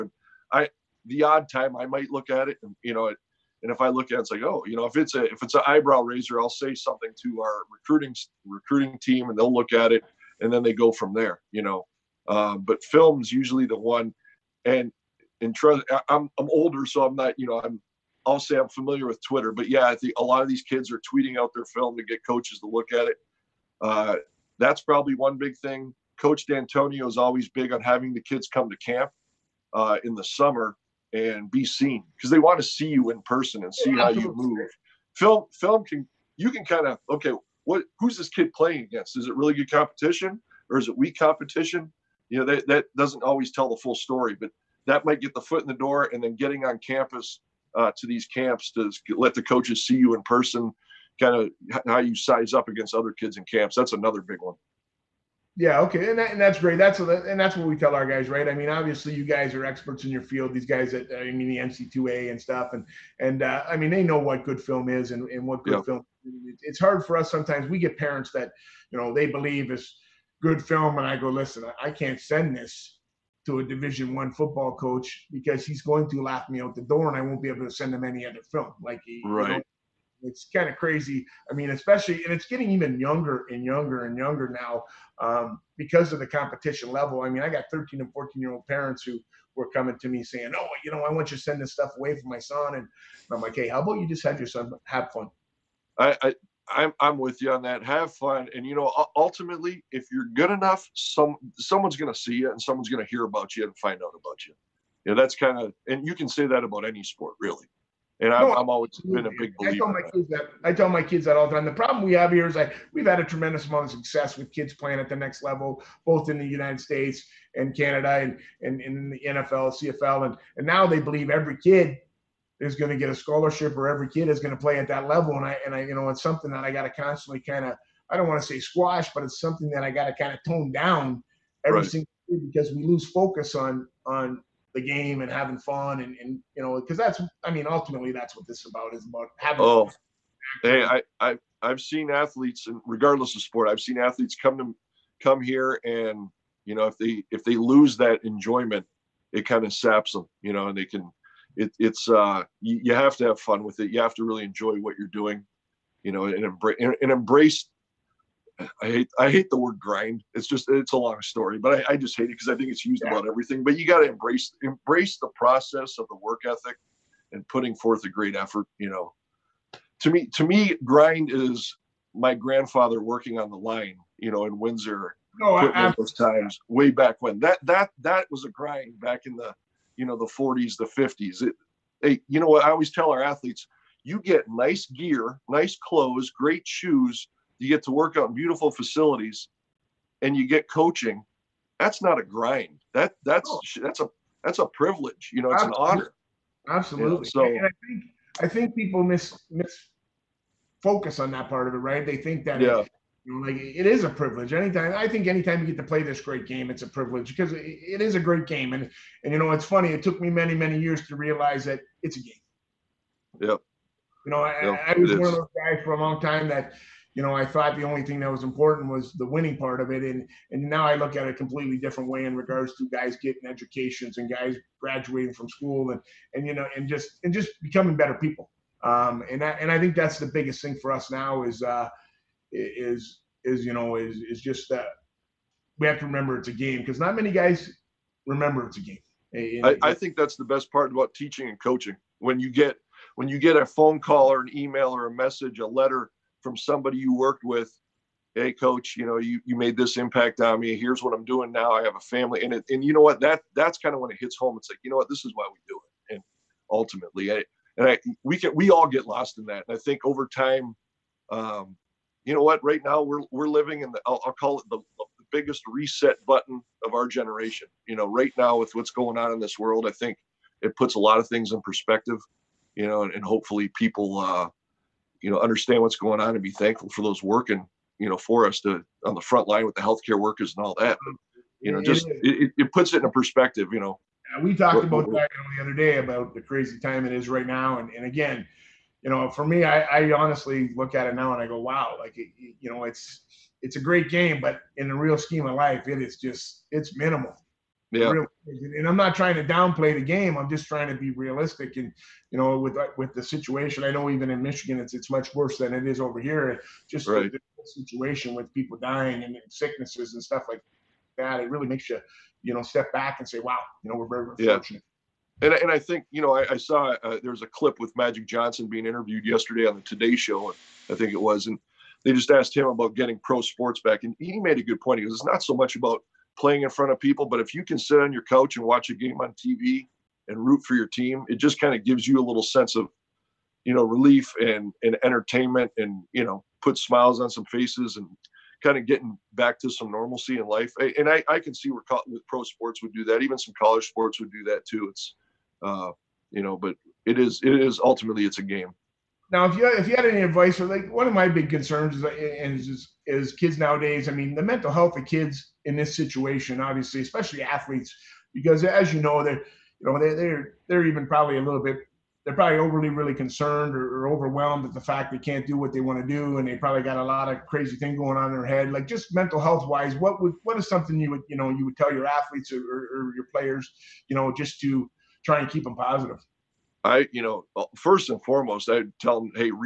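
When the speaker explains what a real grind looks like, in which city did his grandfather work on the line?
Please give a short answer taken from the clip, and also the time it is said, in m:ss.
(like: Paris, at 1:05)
Windsor, at 2:54.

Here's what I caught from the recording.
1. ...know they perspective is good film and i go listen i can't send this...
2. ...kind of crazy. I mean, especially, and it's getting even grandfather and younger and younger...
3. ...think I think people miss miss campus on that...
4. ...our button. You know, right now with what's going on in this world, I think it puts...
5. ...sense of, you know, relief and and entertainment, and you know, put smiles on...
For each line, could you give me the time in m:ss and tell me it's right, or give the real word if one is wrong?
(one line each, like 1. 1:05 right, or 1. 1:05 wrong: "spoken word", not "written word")
1. 1:08 wrong: "believe", not "perspective"
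2. 1:20 wrong: "younger", not "grandfather"
3. 3:17 wrong: "focus", not "campus"
4. 4:26 wrong: "generation", not "button"
5. 5:32 right.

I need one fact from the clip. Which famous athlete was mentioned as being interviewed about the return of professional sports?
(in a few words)
Magic Johnson.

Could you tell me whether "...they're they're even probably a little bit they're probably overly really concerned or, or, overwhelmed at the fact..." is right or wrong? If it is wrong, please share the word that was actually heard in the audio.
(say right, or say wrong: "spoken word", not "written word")
right.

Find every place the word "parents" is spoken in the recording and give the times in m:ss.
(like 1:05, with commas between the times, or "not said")
1:07, 1:28.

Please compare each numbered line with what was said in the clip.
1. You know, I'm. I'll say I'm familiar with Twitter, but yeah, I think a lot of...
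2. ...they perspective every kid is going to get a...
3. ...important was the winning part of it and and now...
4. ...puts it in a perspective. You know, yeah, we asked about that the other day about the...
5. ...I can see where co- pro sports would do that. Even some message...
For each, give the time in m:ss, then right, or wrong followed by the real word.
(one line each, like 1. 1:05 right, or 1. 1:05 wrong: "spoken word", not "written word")
1. 0:17 right
2. 2:00 wrong: "believe", not "perspective"
3. 3:38 right
4. 4:42 wrong: "talked", not "asked"
5. 5:41 wrong: "college", not "message".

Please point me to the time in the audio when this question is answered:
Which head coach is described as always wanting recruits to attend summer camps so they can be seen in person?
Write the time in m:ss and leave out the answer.
0:26.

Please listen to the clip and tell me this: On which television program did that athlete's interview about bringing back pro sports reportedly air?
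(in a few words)
the Today Show.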